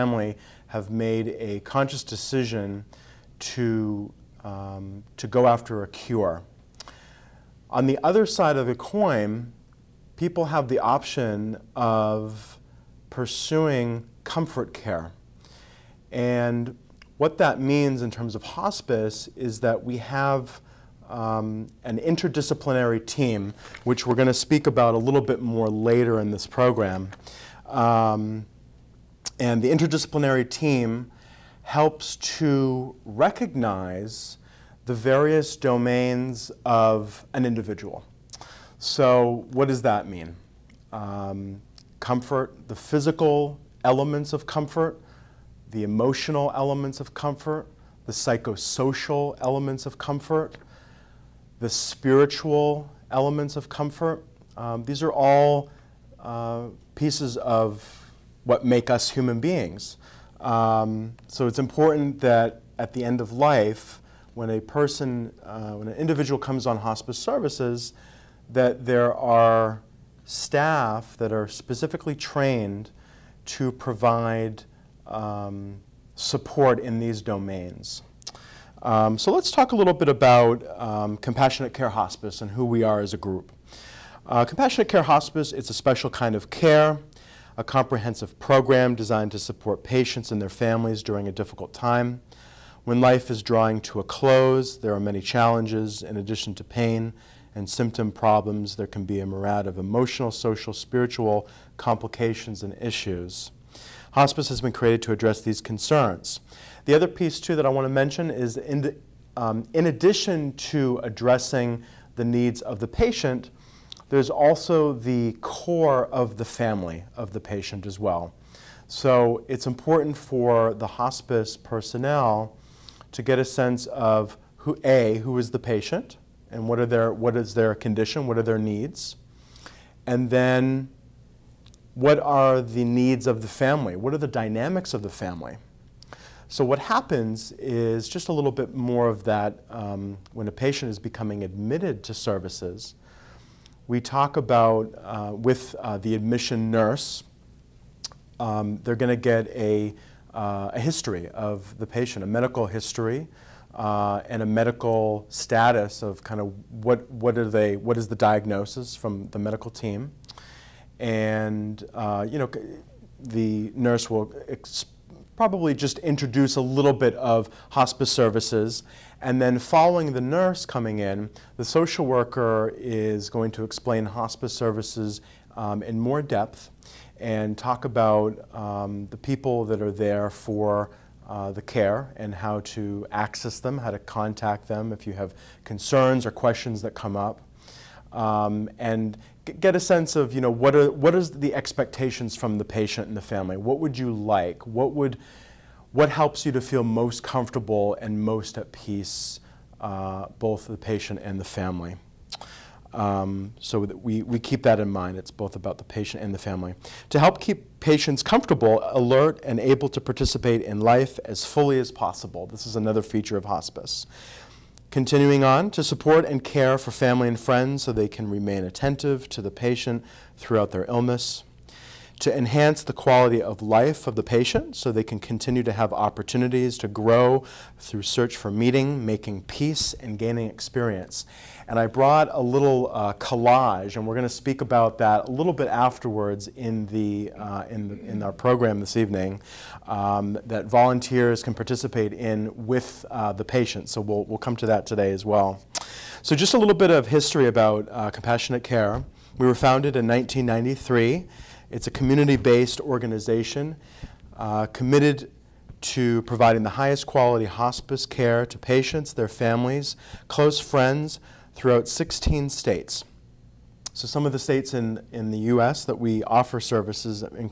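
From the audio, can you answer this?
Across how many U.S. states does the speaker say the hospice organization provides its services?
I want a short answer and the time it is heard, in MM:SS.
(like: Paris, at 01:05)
16, at 04:21.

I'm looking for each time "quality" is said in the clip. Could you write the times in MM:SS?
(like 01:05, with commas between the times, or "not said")
03:42, 04:17.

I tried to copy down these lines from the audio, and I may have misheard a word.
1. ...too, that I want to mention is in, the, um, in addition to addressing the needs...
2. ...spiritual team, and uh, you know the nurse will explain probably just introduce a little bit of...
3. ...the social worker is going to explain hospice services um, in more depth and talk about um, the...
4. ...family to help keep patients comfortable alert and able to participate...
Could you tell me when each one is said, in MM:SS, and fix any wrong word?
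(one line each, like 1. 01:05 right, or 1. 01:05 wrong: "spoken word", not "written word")
1. 01:47 right
2. 02:39 wrong: "medical", not "spiritual"
3. 02:51 right
4. 03:26 right.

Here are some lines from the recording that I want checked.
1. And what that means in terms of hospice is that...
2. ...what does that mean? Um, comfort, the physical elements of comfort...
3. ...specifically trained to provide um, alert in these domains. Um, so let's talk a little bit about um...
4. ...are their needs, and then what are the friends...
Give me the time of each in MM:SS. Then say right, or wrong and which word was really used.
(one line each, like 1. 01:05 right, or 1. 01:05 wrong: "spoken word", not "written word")
1. 00:16 right
2. 00:39 right
3. 01:11 wrong: "support", not "alert"
4. 02:08 wrong: "needs", not "friends".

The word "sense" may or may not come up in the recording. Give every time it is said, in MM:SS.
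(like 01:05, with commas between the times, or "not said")
02:03, 03:09.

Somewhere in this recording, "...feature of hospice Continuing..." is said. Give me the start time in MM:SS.
03:33.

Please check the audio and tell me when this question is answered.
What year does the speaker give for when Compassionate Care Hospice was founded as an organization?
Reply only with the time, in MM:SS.
04:10.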